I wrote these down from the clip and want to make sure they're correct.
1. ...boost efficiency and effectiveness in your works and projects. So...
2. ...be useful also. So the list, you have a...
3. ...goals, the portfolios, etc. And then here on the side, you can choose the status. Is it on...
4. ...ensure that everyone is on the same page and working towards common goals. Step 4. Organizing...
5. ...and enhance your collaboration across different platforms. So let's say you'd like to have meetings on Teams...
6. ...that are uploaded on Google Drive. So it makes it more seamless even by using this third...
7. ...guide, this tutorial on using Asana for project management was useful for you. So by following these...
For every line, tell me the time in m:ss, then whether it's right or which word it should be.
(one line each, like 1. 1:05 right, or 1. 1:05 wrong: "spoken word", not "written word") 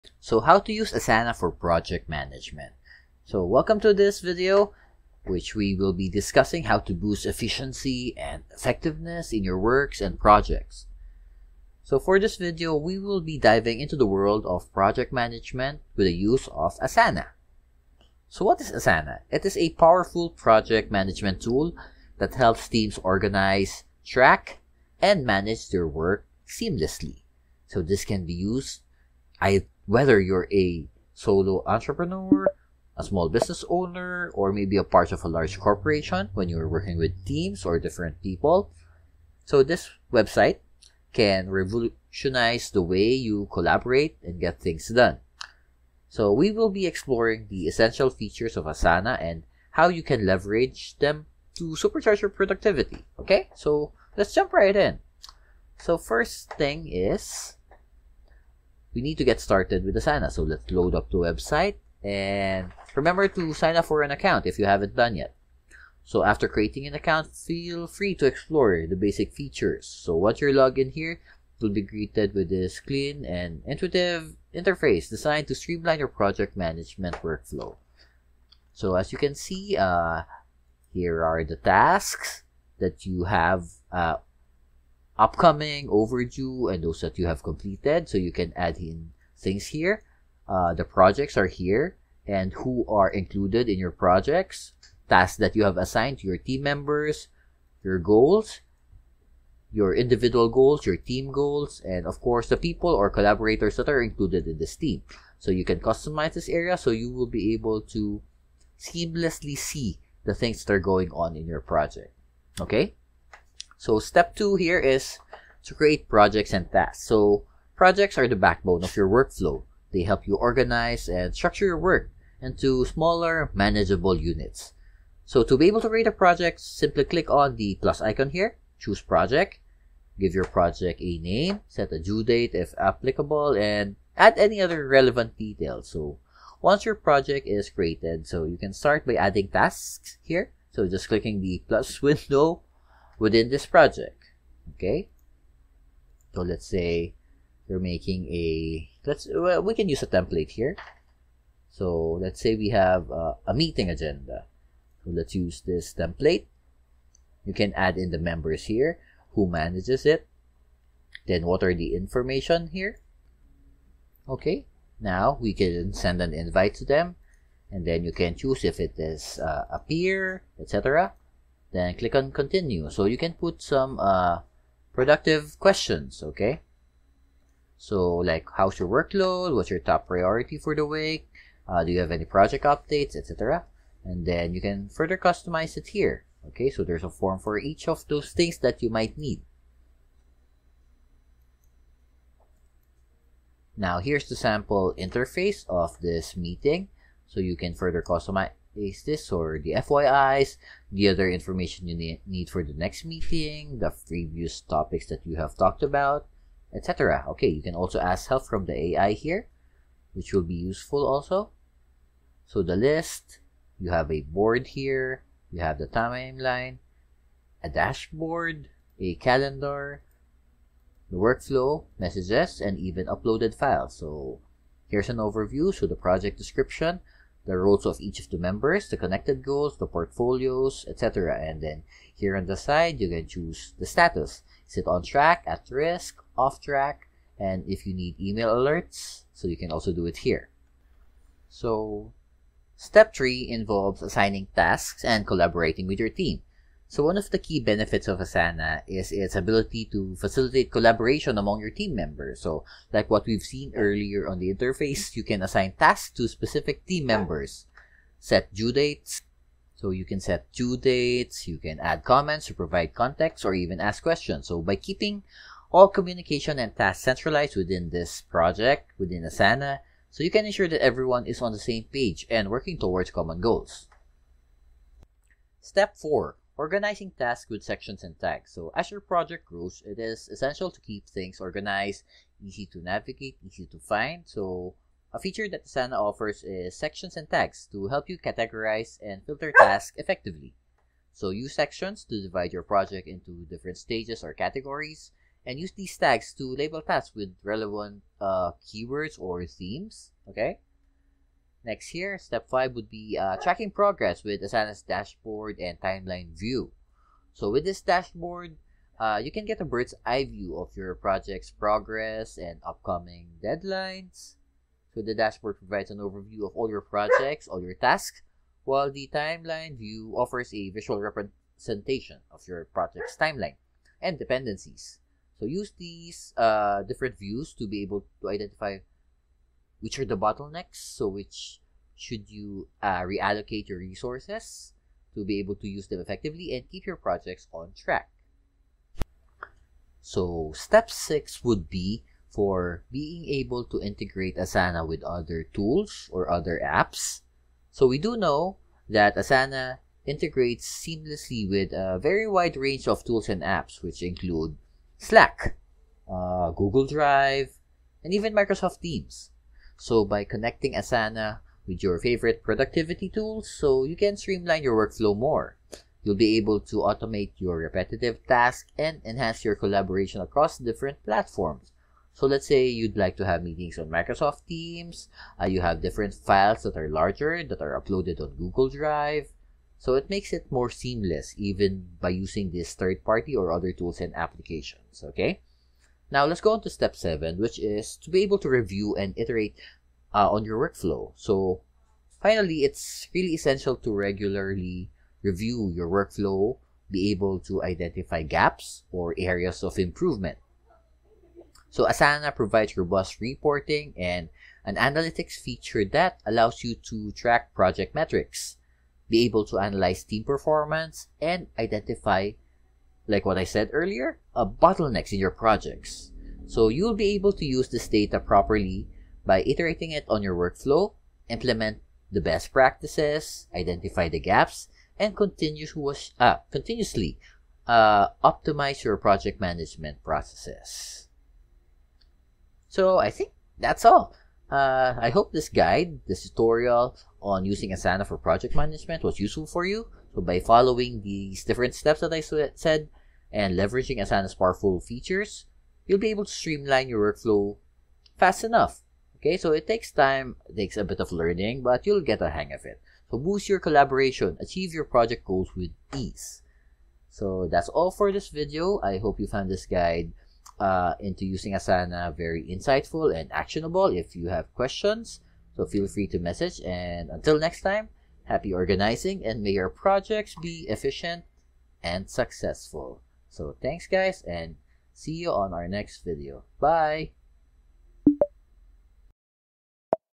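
1. 0:06 right
2. 3:30 right
3. 3:49 right
4. 4:30 right
5. 6:08 wrong: "Microsoft", not "Teams"
6. 6:17 right
7. 7:15 right.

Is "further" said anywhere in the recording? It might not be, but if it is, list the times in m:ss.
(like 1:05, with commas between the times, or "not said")
3:04, 3:17.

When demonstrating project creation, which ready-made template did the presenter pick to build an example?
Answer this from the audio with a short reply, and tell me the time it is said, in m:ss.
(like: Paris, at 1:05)
Meeting agenda, at 2:33.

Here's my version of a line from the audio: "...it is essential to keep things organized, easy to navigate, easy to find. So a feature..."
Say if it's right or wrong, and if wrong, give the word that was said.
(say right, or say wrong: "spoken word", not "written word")
right.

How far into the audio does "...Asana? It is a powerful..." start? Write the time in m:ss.
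0:18.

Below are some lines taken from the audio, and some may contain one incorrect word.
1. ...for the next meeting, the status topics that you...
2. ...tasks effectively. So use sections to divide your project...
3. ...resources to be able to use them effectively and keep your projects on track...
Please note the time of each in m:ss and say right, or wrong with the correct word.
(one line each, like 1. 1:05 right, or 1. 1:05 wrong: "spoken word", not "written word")
1. 3:22 wrong: "previous", not "status"
2. 4:49 right
3. 5:33 right.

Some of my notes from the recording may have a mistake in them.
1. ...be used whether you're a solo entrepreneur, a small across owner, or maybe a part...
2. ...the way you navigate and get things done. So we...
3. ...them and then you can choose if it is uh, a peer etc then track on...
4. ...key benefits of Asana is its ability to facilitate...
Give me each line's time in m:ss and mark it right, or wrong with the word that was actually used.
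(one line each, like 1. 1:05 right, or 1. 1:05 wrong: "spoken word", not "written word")
1. 0:28 wrong: "business", not "across"
2. 0:42 wrong: "collaborate", not "navigate"
3. 2:46 wrong: "click", not "track"
4. 4:07 right.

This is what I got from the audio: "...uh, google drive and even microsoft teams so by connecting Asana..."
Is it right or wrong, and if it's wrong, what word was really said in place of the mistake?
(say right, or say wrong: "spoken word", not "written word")
right.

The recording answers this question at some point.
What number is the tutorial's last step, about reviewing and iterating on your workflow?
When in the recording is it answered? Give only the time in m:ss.
6:26.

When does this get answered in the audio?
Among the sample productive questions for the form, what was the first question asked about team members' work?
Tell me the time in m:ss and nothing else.
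2:58.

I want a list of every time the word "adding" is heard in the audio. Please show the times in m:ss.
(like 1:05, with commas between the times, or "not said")
2:19.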